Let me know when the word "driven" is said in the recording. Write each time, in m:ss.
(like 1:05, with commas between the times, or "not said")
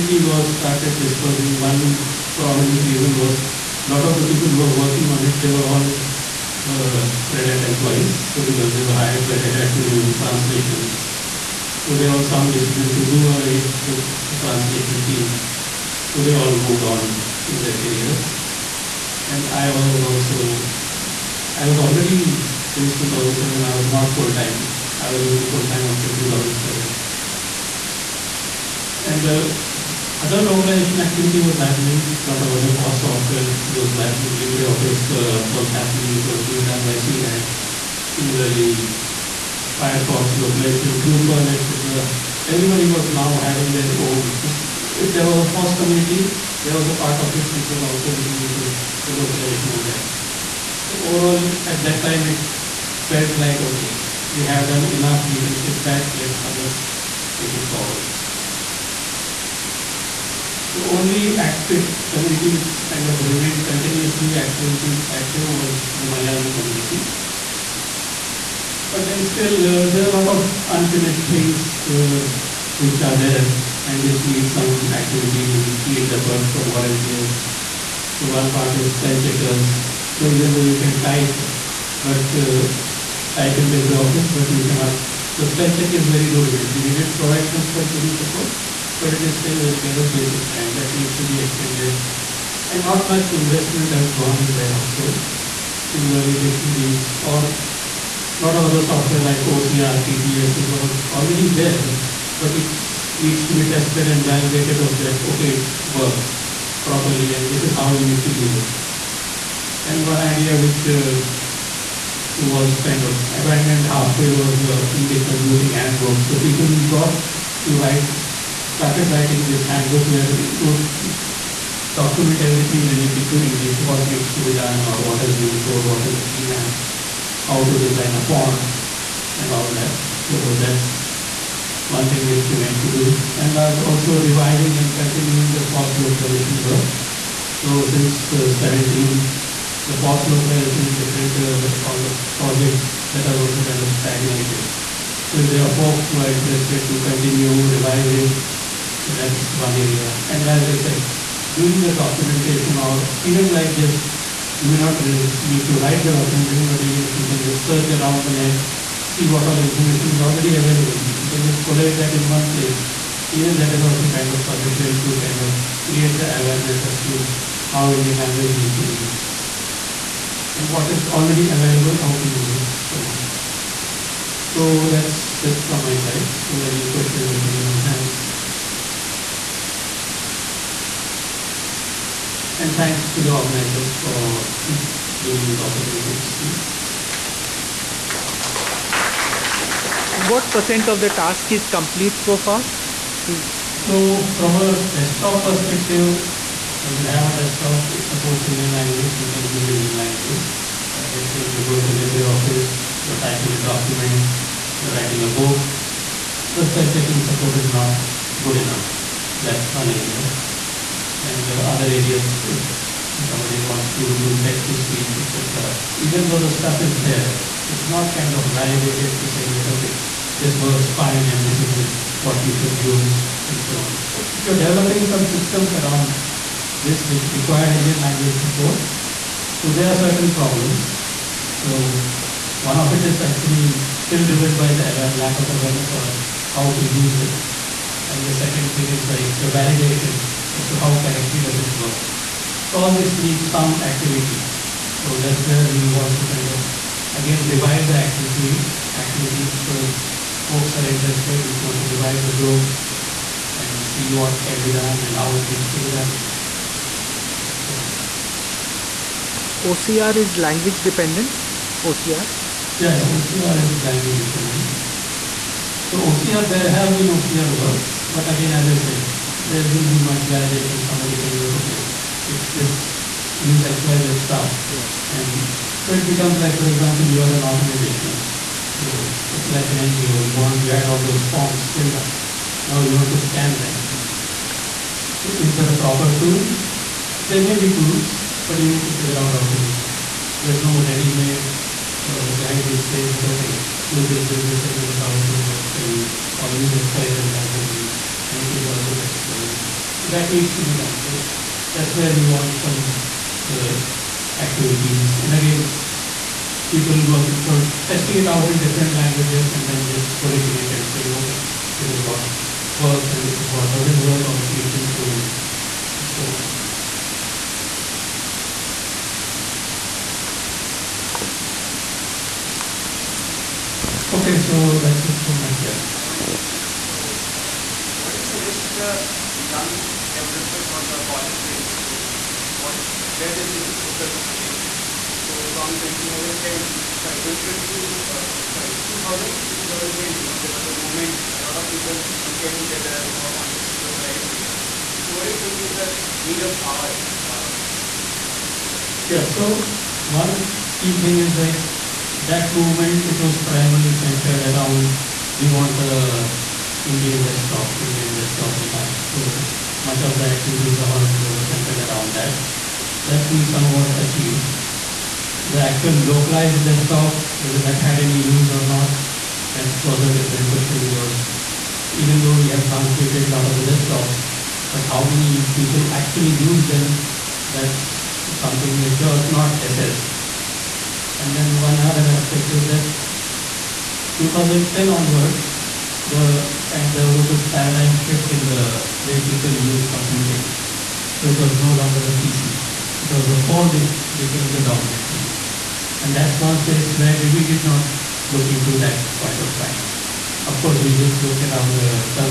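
3:54.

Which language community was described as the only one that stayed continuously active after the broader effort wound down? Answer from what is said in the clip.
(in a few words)
Malayalam.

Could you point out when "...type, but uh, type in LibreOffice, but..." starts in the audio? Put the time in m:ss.
1:21.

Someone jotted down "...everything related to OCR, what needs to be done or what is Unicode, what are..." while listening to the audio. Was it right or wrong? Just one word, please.
wrong.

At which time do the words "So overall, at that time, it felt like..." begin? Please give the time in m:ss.
0:50.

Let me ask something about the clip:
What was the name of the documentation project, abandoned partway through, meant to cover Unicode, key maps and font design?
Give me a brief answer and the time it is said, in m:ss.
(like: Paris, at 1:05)
Indic Computing Handbook, at 1:54.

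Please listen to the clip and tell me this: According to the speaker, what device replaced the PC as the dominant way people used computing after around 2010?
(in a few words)
The phone.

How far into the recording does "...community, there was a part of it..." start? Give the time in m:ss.
0:45.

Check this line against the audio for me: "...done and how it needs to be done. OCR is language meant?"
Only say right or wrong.
wrong.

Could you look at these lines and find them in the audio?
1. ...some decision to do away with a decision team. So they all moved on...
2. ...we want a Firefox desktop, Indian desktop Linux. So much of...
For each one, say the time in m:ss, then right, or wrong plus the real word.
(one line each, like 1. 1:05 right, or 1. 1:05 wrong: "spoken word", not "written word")
1. 0:12 wrong: "translation", not "decision"
2. 5:55 wrong: "Indian", not "Firefox".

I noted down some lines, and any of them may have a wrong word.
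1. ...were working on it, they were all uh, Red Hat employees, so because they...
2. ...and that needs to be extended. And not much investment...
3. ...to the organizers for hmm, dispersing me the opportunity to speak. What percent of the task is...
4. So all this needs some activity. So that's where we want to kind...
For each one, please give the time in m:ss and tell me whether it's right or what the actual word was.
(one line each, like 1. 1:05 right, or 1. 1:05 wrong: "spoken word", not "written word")
1. 0:04 right
2. 1:30 right
3. 3:03 wrong: "giving", not "dispersing"
4. 4:02 right.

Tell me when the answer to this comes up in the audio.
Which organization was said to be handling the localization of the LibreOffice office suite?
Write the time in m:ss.
0:36.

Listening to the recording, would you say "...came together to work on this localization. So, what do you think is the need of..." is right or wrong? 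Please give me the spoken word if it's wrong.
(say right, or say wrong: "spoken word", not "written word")
right.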